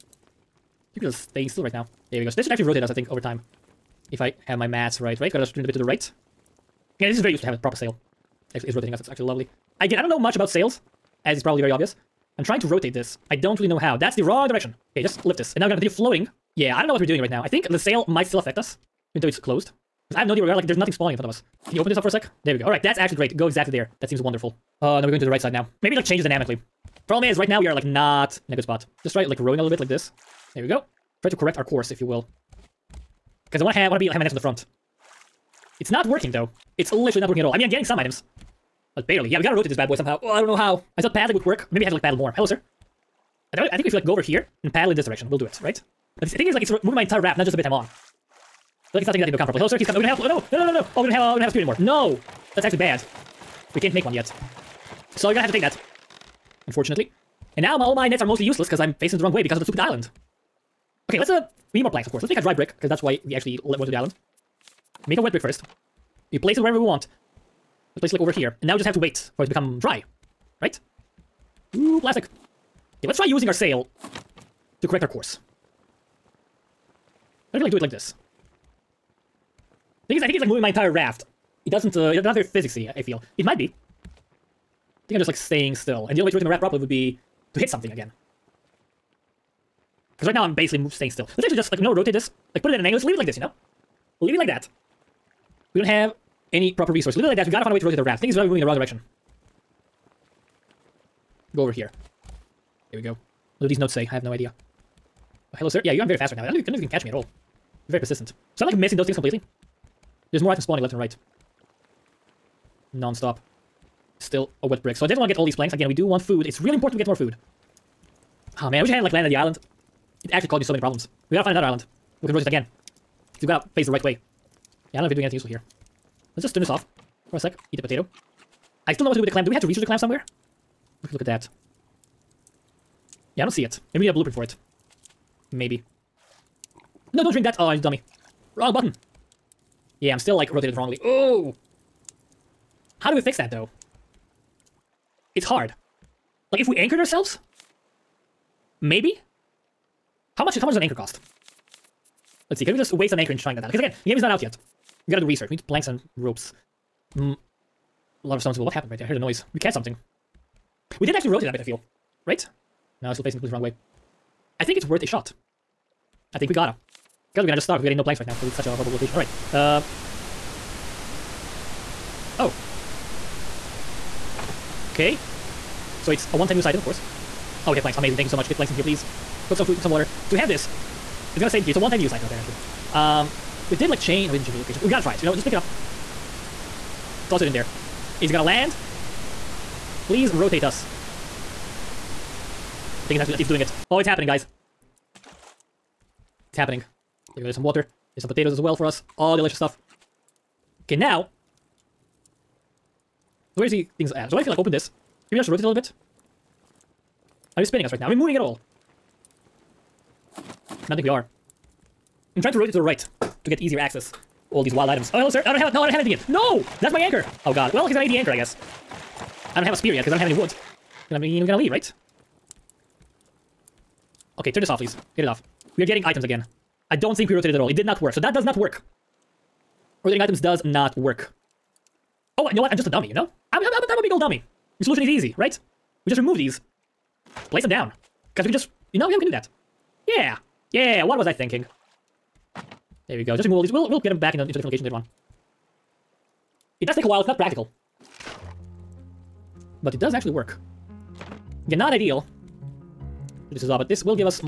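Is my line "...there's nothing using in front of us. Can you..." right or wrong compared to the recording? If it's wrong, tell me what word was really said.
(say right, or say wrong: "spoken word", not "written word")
wrong: "spawning", not "using".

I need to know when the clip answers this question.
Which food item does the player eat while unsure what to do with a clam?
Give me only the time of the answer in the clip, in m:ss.
2:07.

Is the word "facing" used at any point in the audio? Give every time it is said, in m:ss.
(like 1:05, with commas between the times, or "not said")
0:58, 2:43.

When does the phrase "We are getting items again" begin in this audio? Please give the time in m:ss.
3:45.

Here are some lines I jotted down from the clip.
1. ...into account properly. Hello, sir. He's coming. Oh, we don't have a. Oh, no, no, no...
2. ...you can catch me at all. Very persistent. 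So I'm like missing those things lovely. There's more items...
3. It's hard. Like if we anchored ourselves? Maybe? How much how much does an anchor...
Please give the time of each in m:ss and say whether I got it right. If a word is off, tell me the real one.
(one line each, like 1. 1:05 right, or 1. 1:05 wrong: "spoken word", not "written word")
1. 0:49 right
2. 1:46 wrong: "completely", not "lovely"
3. 2:25 right.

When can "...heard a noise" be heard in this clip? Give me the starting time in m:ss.
2:39.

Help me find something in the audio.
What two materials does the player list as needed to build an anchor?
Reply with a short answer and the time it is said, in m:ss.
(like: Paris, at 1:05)
Planks and ropes, at 2:35.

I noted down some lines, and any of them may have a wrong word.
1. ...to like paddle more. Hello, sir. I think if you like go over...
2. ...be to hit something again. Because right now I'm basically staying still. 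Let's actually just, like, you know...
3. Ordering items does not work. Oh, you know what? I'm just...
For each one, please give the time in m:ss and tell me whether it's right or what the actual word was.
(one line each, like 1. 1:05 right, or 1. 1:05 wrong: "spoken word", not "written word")
1. 0:41 right
2. 1:26 right
3. 3:50 right.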